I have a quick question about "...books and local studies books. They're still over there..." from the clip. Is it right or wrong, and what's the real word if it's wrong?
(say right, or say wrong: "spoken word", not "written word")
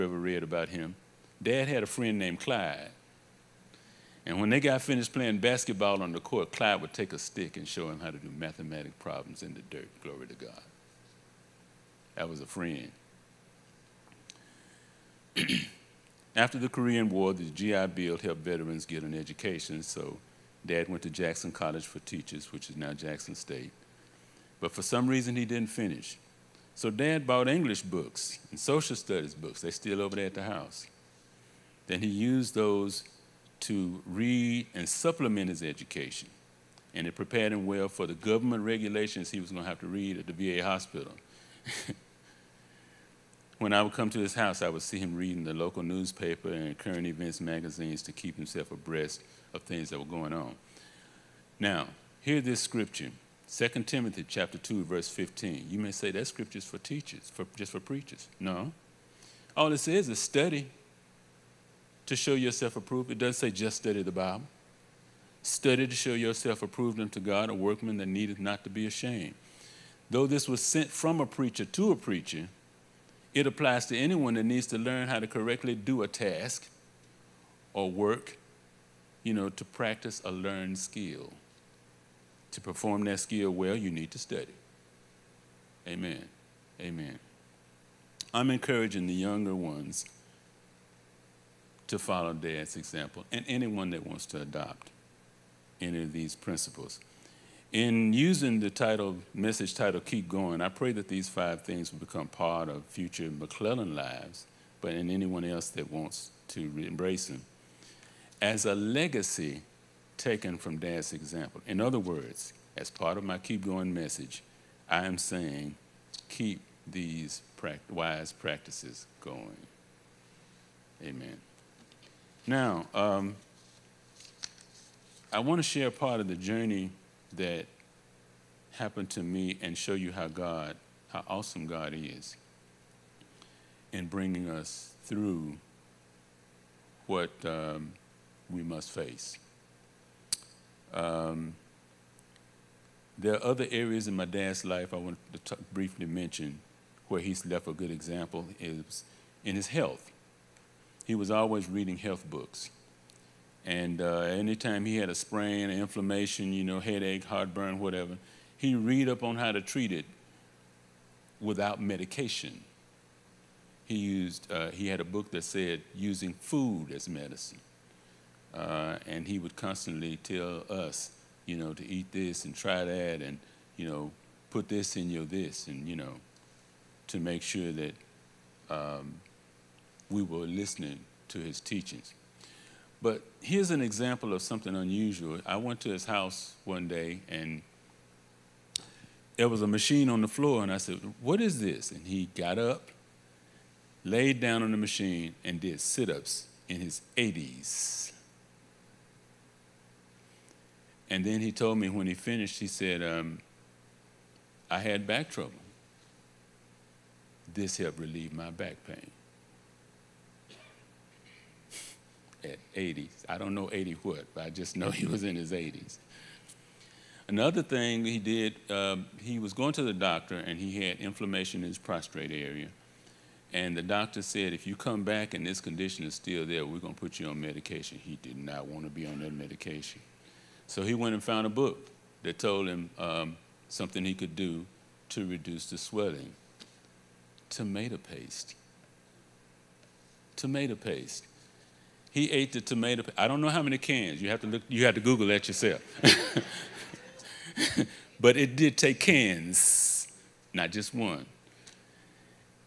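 wrong: "social", not "local".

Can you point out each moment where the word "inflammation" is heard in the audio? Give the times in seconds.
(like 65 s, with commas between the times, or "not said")
155 s, 220 s.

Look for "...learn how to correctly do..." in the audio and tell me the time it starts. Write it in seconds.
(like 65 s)
74 s.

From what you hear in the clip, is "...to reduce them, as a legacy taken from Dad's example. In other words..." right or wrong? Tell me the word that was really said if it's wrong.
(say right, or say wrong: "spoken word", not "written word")
wrong: "embrace", not "reduce".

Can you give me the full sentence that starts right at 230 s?
So he went and found a book that told him um, something he could do to reduce the swelling: tomato paste.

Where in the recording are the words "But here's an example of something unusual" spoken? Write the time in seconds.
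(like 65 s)
183 s.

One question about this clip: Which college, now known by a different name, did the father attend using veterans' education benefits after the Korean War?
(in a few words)
Jackson College for Teachers.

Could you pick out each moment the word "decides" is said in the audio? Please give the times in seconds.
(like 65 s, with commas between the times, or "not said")
not said.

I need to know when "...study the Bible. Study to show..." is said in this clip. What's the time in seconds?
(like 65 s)
63 s.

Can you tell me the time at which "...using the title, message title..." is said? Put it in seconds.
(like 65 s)
98 s.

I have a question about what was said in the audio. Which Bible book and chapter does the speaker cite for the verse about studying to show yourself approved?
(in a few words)
2 Timothy chapter 2.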